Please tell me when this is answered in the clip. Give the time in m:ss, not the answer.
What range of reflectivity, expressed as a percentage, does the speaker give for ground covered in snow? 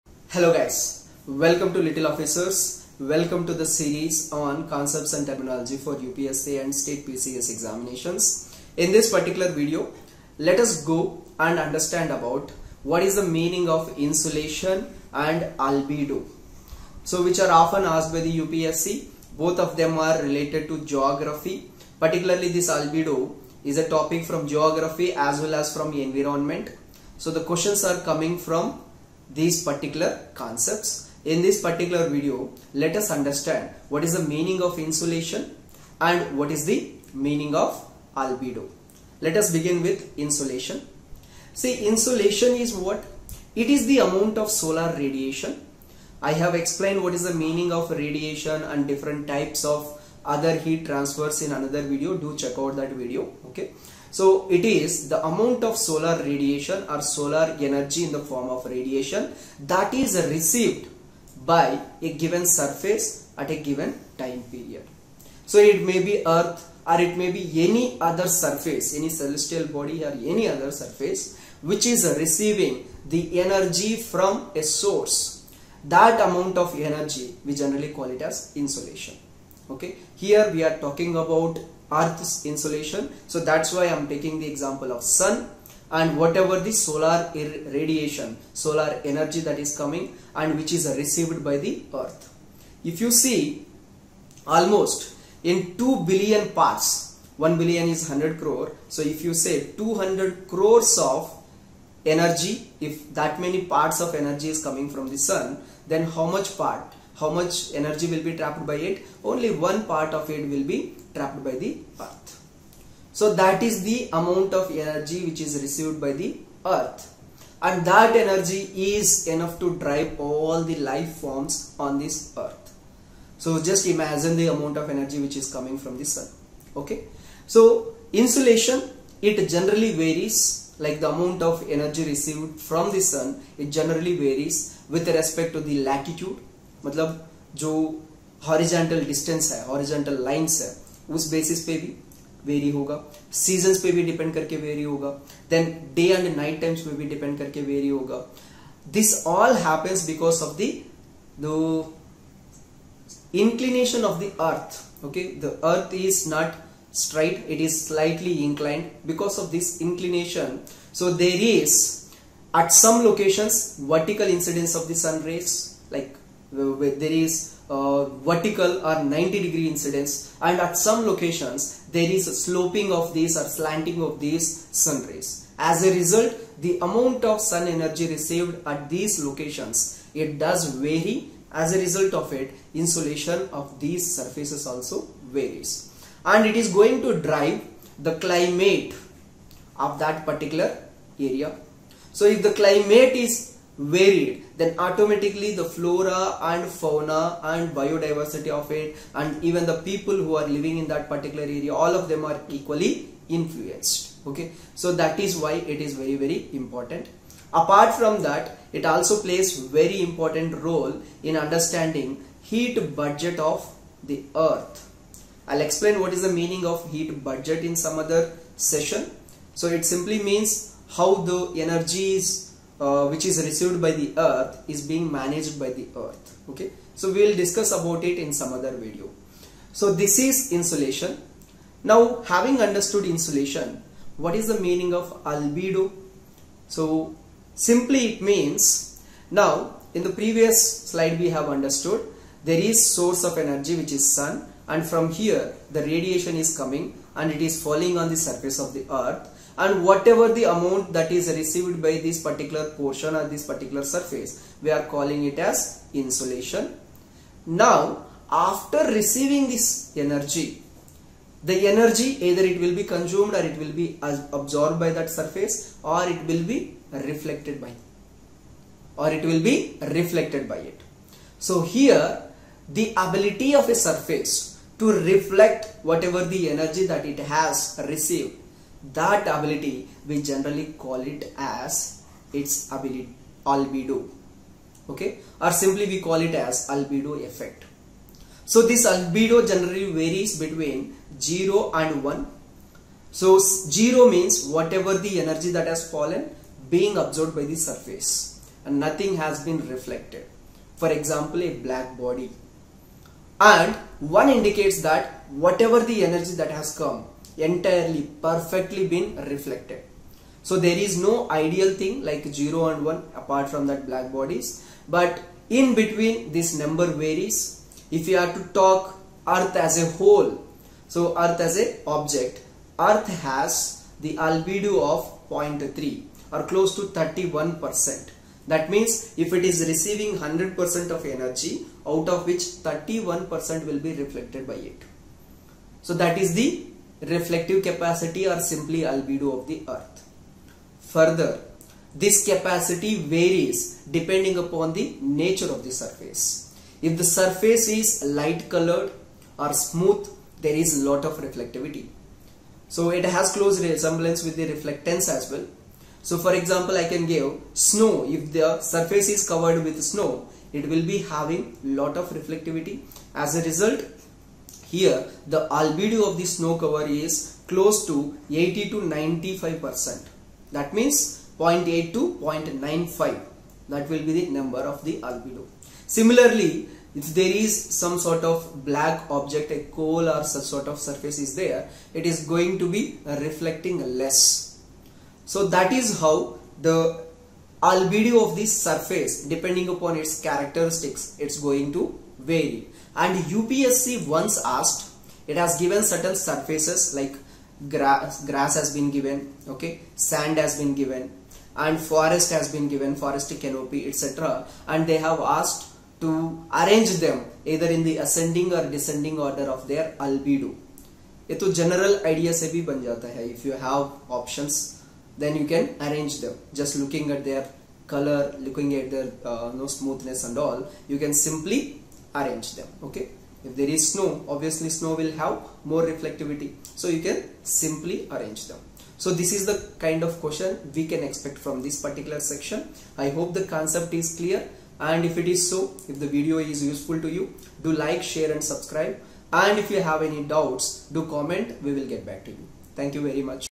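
6:08.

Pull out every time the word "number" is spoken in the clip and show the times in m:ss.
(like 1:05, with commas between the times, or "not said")
5:16, 6:14.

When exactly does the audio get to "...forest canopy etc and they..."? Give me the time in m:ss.
6:42.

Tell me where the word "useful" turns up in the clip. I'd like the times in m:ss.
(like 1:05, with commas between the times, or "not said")
7:16.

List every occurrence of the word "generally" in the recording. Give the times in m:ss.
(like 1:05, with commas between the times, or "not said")
1:17, 2:09, 2:13, 4:40, 4:49.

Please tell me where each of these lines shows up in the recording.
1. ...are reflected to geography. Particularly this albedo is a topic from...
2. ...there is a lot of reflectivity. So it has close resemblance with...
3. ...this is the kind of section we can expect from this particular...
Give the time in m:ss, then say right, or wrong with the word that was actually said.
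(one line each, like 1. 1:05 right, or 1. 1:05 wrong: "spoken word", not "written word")
1. 0:19 wrong: "related", not "reflected"
2. 5:50 right
3. 7:09 wrong: "question", not "section".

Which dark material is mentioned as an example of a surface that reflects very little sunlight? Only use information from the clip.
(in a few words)
coal.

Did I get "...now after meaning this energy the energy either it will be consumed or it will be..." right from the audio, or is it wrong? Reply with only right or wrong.
wrong.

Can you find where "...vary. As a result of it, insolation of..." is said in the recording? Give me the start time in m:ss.
3:00.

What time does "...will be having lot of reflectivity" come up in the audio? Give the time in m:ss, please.
6:00.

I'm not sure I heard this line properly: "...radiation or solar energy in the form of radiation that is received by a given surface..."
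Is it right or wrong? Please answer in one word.
right.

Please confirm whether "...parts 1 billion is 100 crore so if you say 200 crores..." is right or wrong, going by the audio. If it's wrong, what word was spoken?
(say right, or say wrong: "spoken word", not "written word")
right.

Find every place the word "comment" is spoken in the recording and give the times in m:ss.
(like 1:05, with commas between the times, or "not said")
7:21.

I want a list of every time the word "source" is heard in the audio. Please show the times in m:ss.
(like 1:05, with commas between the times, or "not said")
1:14, 4:02.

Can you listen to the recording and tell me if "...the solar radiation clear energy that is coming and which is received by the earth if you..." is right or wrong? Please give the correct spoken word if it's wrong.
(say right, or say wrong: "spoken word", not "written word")
wrong: "solar", not "clear".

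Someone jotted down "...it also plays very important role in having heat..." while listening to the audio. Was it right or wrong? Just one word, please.
wrong.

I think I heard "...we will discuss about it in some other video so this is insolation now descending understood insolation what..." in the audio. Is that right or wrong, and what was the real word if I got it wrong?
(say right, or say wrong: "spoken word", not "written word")
wrong: "having", not "descending".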